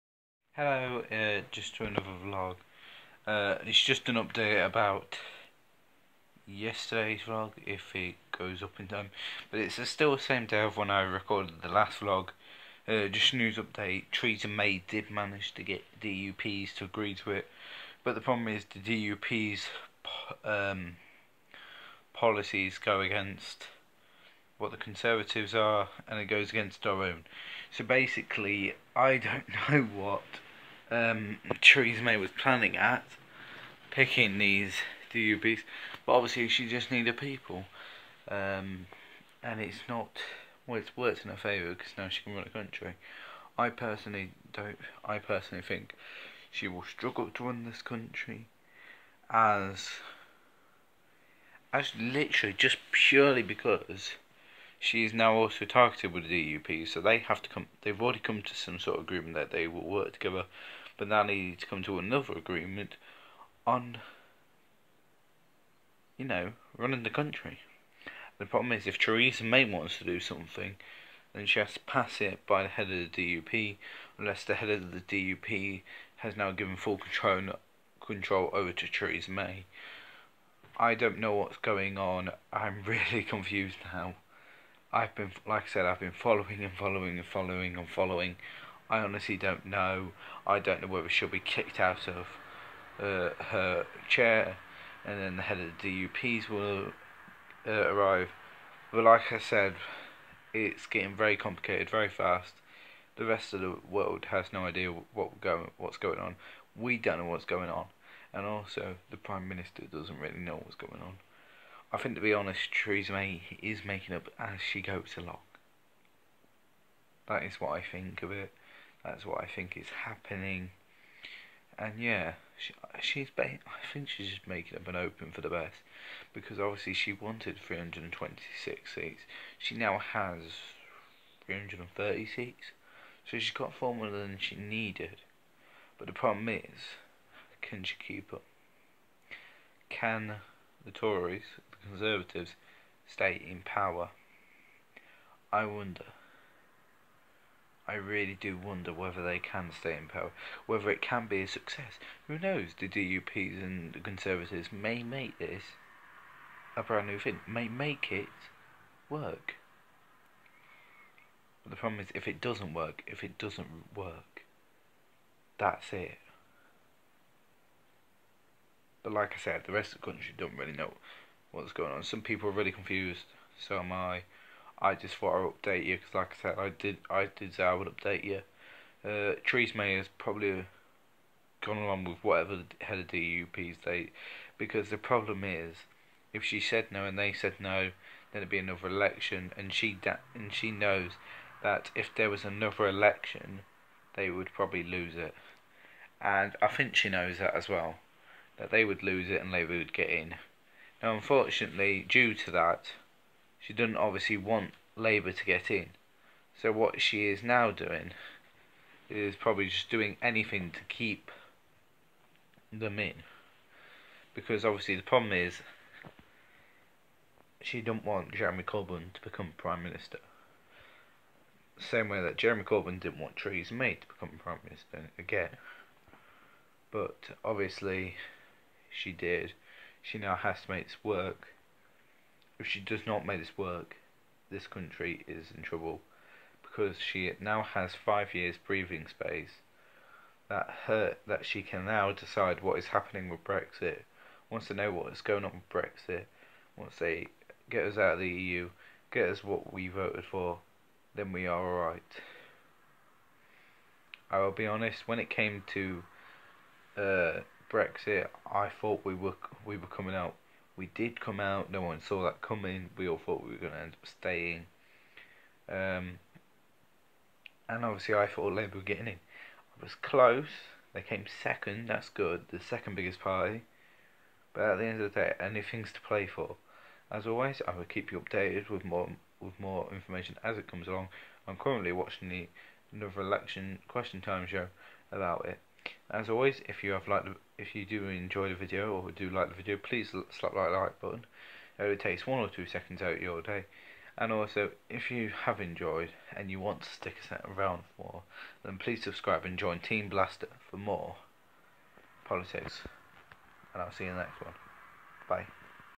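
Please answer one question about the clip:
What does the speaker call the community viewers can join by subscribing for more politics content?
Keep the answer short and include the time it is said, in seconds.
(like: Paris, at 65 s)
Team Blaster, at 299 s.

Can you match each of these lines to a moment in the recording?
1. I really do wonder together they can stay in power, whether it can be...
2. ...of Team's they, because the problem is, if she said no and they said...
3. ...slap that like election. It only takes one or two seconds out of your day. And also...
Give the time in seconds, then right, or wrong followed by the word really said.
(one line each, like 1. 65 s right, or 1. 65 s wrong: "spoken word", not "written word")
1. 147 s wrong: "whether", not "together"
2. 182 s wrong: "DUP", not "Team"
3. 290 s wrong: "button", not "election".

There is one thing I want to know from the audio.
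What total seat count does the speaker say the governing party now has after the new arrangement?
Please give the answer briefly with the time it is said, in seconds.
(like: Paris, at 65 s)
330, at 131 s.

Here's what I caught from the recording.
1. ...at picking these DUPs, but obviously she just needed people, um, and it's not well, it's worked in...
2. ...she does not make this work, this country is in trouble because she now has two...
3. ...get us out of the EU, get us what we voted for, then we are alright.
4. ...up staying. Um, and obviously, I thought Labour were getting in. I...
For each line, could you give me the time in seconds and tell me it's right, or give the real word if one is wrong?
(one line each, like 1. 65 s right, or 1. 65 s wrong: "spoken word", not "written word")
1. 32 s right
2. 232 s wrong: "five", not "two"
3. 247 s right
4. 263 s right.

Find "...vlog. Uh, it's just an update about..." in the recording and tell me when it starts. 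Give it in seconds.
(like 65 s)
2 s.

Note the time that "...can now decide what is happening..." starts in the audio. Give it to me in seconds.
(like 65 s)
241 s.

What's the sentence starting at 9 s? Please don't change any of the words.
But it's still the same day of when I recorded the last vlog.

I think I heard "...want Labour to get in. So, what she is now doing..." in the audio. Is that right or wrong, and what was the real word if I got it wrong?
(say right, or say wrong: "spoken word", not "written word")
right.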